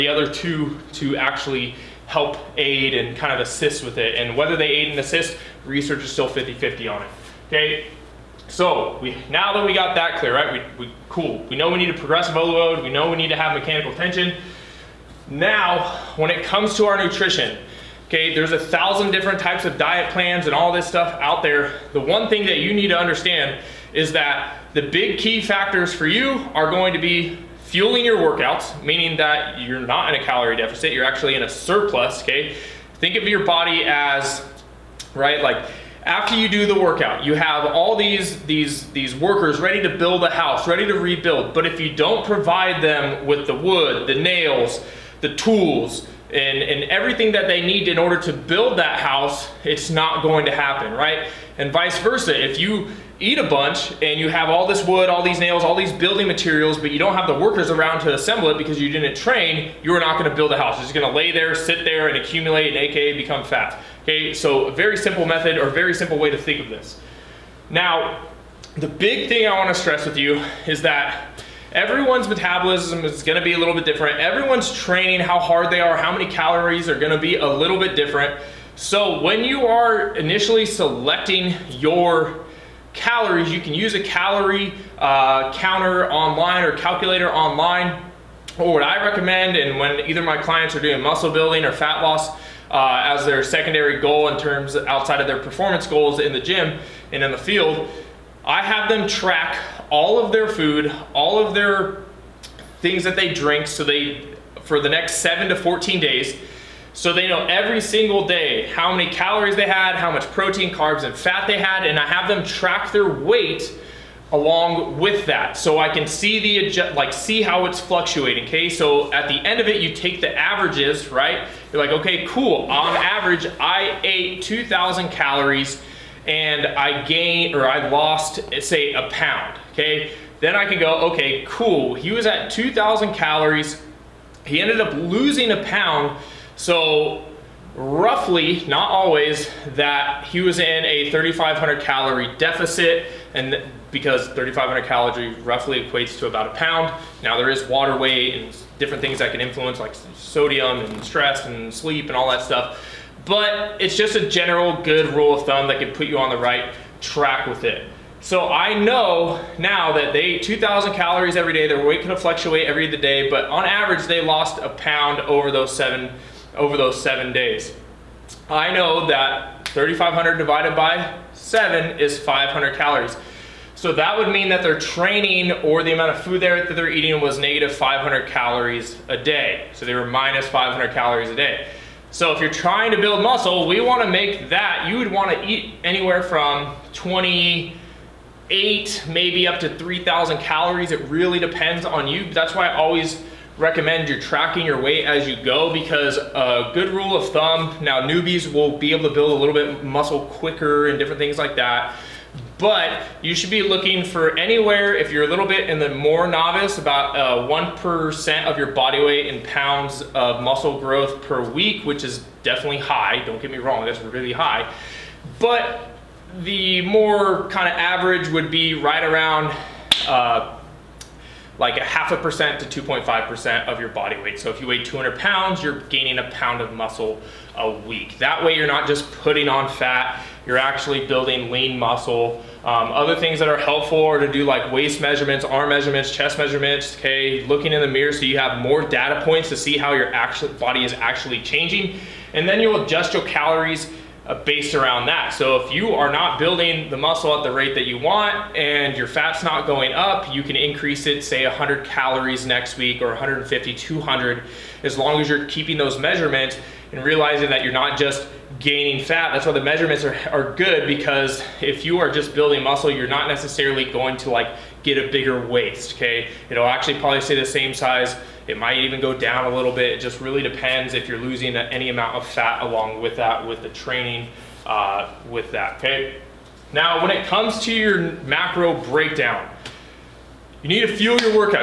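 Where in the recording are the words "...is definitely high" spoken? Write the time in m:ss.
3:32.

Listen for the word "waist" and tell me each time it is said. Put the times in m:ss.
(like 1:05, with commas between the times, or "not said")
3:54, 4:25.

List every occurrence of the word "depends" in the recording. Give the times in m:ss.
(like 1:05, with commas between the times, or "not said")
3:11, 4:30.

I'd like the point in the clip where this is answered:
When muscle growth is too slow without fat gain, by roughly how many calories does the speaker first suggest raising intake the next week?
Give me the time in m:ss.
4:11.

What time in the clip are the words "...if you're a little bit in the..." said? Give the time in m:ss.
3:24.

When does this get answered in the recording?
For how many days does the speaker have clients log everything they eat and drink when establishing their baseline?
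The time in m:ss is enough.
1:45.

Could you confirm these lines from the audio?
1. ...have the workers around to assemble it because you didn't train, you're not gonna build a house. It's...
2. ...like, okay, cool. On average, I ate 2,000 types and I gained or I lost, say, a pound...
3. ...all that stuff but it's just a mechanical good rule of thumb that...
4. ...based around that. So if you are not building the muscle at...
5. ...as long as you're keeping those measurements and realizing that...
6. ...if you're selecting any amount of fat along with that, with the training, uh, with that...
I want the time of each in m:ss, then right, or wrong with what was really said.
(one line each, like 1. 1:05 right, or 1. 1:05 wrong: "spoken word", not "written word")
1. 0:57 right
2. 2:01 wrong: "calories", not "types"
3. 2:32 wrong: "general", not "mechanical"
4. 4:04 right
5. 4:14 right
6. 4:30 wrong: "losing", not "selecting".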